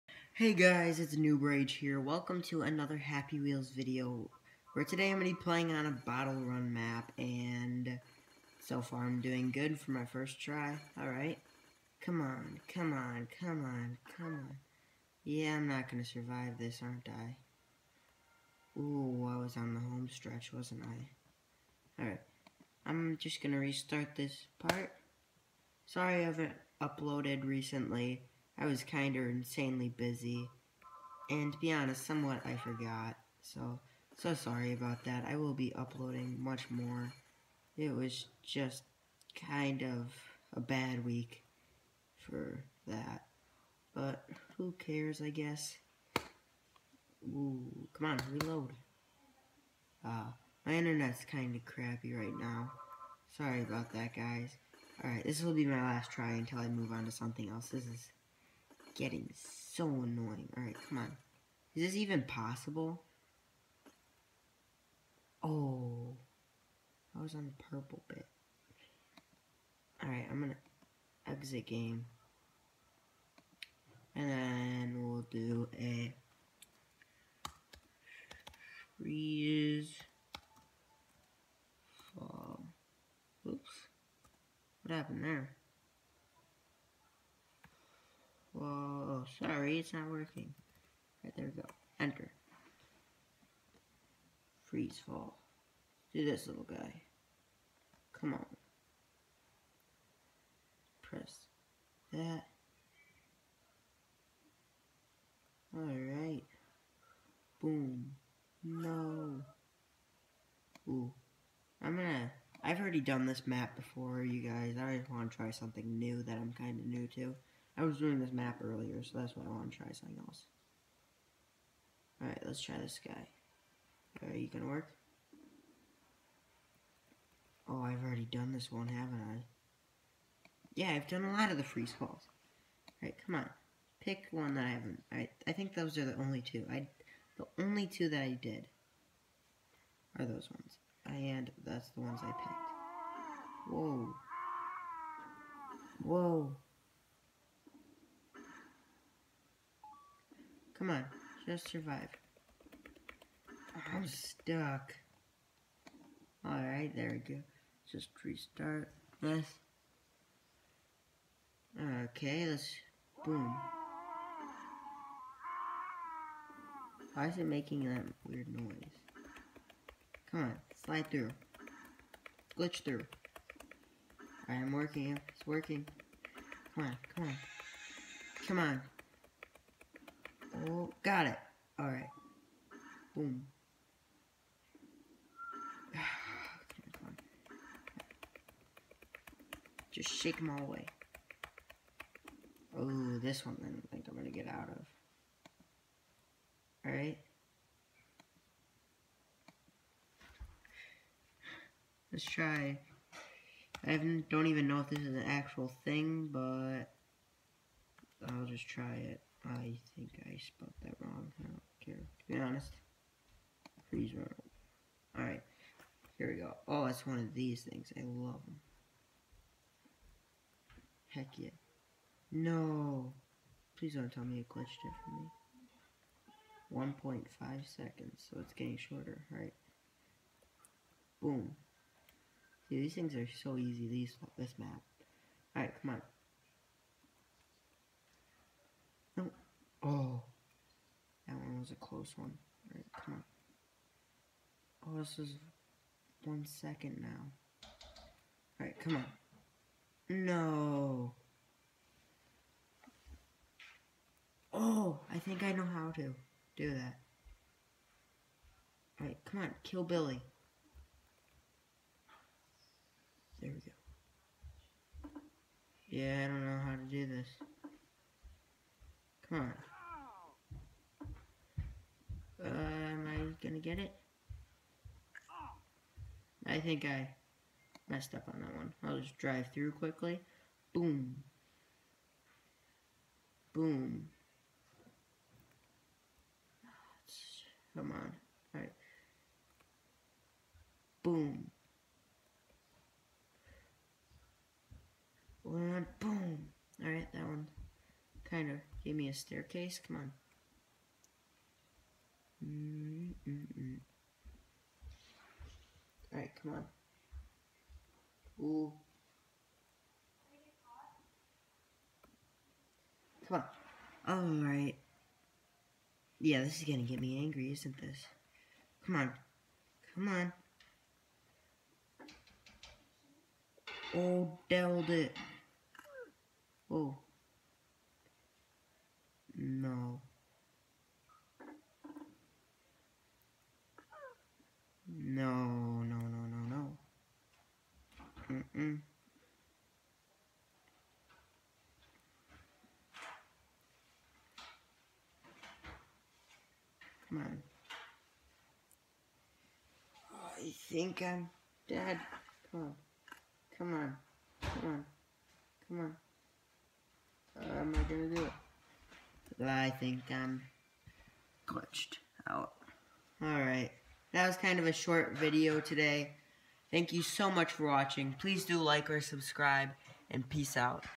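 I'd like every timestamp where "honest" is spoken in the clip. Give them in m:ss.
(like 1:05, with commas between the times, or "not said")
0:31, 3:32.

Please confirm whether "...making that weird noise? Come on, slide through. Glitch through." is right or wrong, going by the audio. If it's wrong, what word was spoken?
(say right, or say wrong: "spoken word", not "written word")
right.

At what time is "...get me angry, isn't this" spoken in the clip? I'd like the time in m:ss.
5:16.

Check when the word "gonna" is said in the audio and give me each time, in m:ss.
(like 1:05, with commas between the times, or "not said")
1:10, 1:51, 2:04, 4:33, 5:16, 5:57.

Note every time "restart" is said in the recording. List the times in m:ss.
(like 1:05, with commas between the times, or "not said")
0:23, 2:38.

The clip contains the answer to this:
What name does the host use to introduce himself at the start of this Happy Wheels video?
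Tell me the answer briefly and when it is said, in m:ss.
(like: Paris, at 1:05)
Noob Rage, at 0:01.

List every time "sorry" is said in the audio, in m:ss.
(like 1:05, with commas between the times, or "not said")
0:25, 0:34, 0:53, 1:29.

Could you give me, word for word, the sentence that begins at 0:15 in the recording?
Yeah, I'm not going to survive this, aren't I?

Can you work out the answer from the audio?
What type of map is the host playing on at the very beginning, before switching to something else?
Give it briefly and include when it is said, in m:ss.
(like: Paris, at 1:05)
Bottle Run, at 0:05.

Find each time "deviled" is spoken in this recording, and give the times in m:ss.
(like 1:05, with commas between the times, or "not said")
5:24.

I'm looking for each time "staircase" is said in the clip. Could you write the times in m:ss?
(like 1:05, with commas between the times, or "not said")
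4:59.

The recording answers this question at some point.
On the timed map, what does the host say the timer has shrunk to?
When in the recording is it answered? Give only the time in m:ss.
3:47.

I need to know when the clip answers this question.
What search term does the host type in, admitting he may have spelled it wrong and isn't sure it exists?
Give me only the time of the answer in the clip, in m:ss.
3:33.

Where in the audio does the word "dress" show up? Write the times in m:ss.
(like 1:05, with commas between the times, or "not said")
not said.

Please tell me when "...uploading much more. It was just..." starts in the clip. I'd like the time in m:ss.
0:35.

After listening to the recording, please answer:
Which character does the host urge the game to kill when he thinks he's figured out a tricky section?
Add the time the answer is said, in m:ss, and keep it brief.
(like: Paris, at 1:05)
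Billy, at 4:19.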